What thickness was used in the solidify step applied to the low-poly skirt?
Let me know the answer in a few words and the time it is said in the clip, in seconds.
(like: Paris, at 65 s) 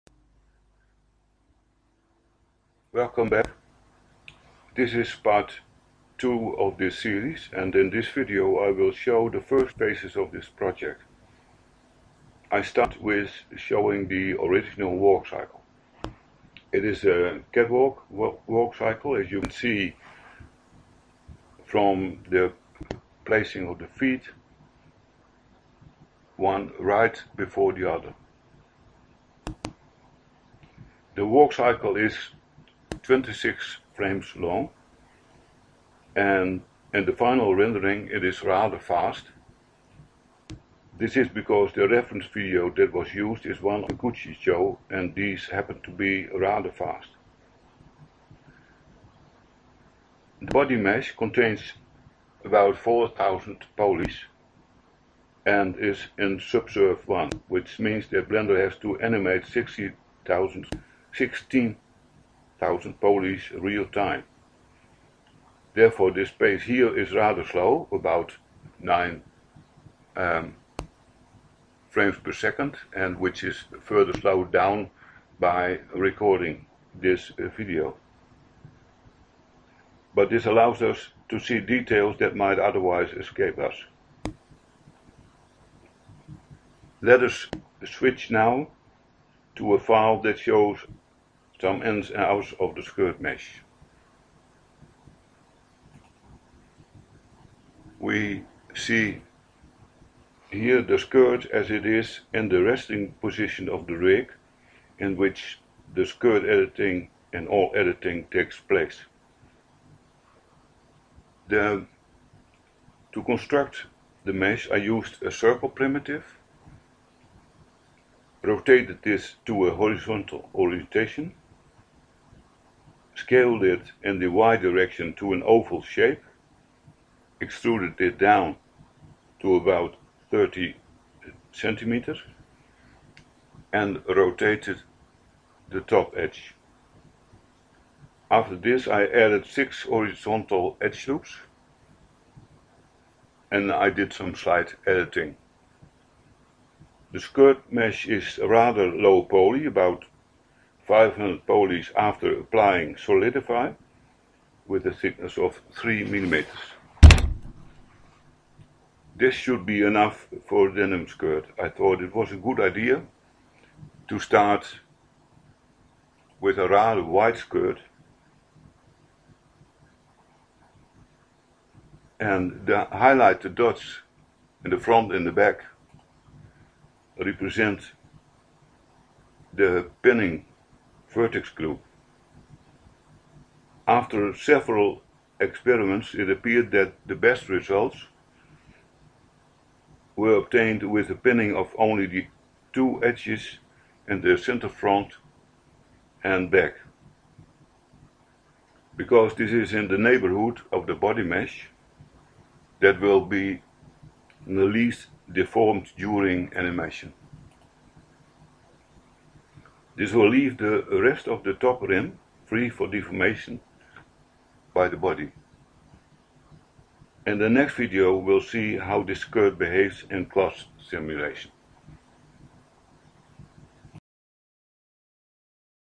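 3 millimeters, at 155 s.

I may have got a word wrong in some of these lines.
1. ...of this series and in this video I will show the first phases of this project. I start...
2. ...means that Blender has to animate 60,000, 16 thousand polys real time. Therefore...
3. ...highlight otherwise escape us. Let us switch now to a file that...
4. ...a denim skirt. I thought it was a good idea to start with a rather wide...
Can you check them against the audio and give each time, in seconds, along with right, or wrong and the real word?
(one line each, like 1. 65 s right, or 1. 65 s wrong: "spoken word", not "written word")
1. 6 s right
2. 57 s right
3. 82 s wrong: "might", not "highlight"
4. 160 s right.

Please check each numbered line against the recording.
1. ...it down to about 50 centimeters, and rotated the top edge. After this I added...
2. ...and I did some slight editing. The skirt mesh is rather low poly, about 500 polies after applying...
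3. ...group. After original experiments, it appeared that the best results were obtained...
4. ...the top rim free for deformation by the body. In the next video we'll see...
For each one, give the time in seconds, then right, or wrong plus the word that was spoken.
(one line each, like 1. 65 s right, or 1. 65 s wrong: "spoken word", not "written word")
1. 128 s wrong: "30", not "50"
2. 143 s right
3. 181 s wrong: "several", not "original"
4. 211 s right.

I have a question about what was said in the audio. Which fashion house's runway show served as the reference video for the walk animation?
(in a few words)
Gucci.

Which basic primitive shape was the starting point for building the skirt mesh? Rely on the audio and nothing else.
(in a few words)
Circle.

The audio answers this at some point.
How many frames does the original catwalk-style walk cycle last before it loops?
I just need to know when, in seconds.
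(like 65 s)
33 s.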